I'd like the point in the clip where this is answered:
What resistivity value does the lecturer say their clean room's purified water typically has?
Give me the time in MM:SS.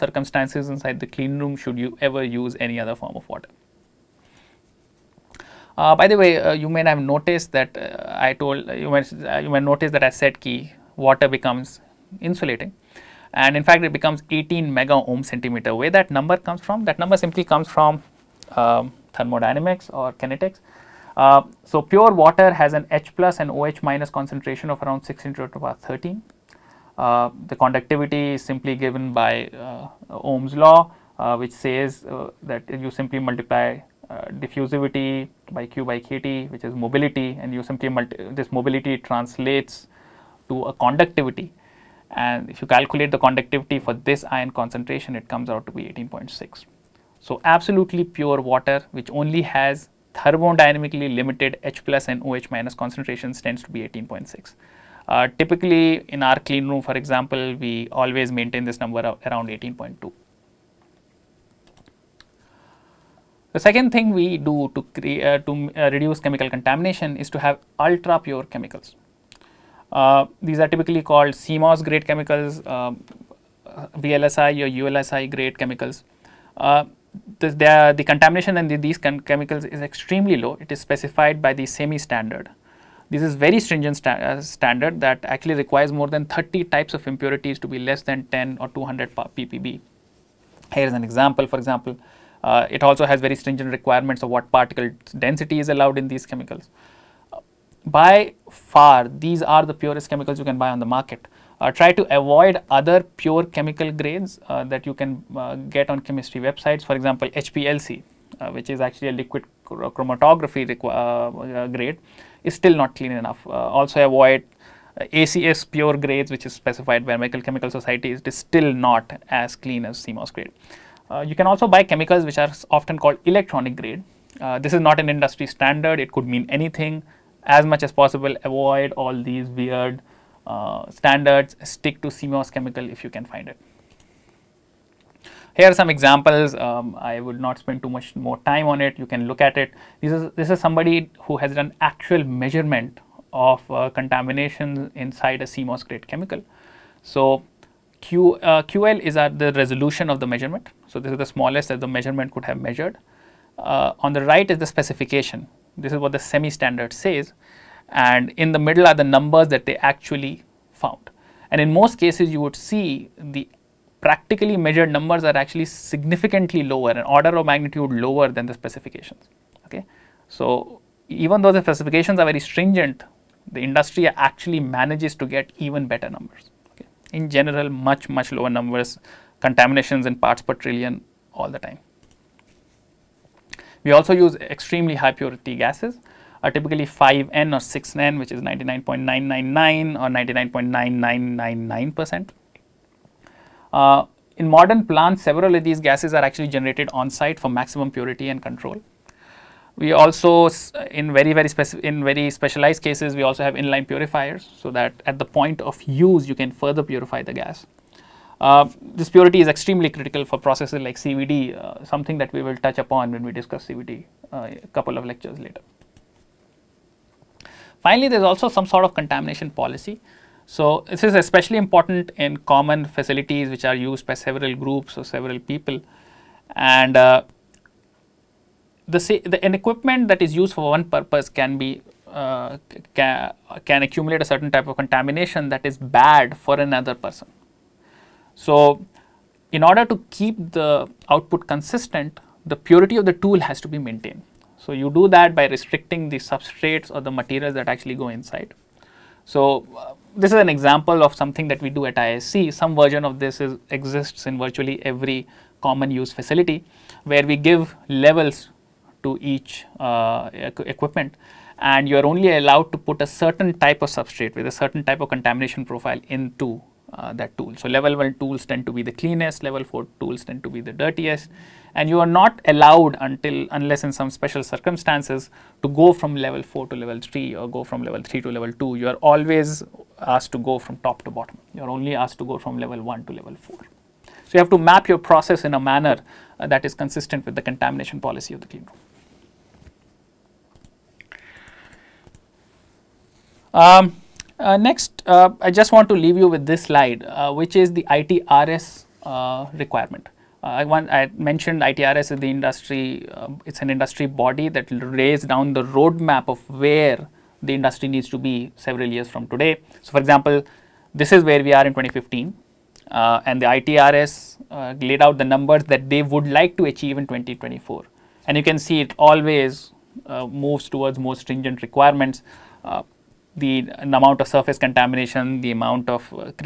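00:59.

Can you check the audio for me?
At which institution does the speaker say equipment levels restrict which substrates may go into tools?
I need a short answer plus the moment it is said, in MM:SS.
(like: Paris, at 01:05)
IISc, at 04:11.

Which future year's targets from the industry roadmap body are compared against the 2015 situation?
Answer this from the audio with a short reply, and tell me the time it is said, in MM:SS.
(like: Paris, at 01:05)
2024, at 05:17.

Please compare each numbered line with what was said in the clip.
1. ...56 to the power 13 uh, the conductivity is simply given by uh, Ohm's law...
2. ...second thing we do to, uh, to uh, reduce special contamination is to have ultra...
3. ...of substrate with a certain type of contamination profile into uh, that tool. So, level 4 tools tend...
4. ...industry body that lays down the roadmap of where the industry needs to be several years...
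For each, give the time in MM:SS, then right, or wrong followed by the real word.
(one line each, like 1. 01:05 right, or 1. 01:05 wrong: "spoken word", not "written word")
1. 00:25 wrong: "16", not "56"
2. 01:03 wrong: "chemical", not "special"
3. 04:23 wrong: "1", not "4"
4. 05:03 right.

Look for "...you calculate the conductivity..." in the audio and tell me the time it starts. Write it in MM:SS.
00:42.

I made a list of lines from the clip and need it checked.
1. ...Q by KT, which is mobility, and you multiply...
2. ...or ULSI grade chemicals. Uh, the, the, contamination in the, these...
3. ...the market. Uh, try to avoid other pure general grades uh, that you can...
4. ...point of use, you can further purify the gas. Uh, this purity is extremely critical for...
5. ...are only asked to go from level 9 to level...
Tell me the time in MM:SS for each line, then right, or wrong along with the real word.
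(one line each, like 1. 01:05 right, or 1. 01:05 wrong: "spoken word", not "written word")
1. 00:35 wrong: "simply", not "multiply"
2. 01:14 right
3. 01:40 wrong: "chemical", not "general"
4. 03:25 right
5. 04:41 wrong: "1", not "9".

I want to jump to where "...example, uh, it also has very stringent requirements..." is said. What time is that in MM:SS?
01:31.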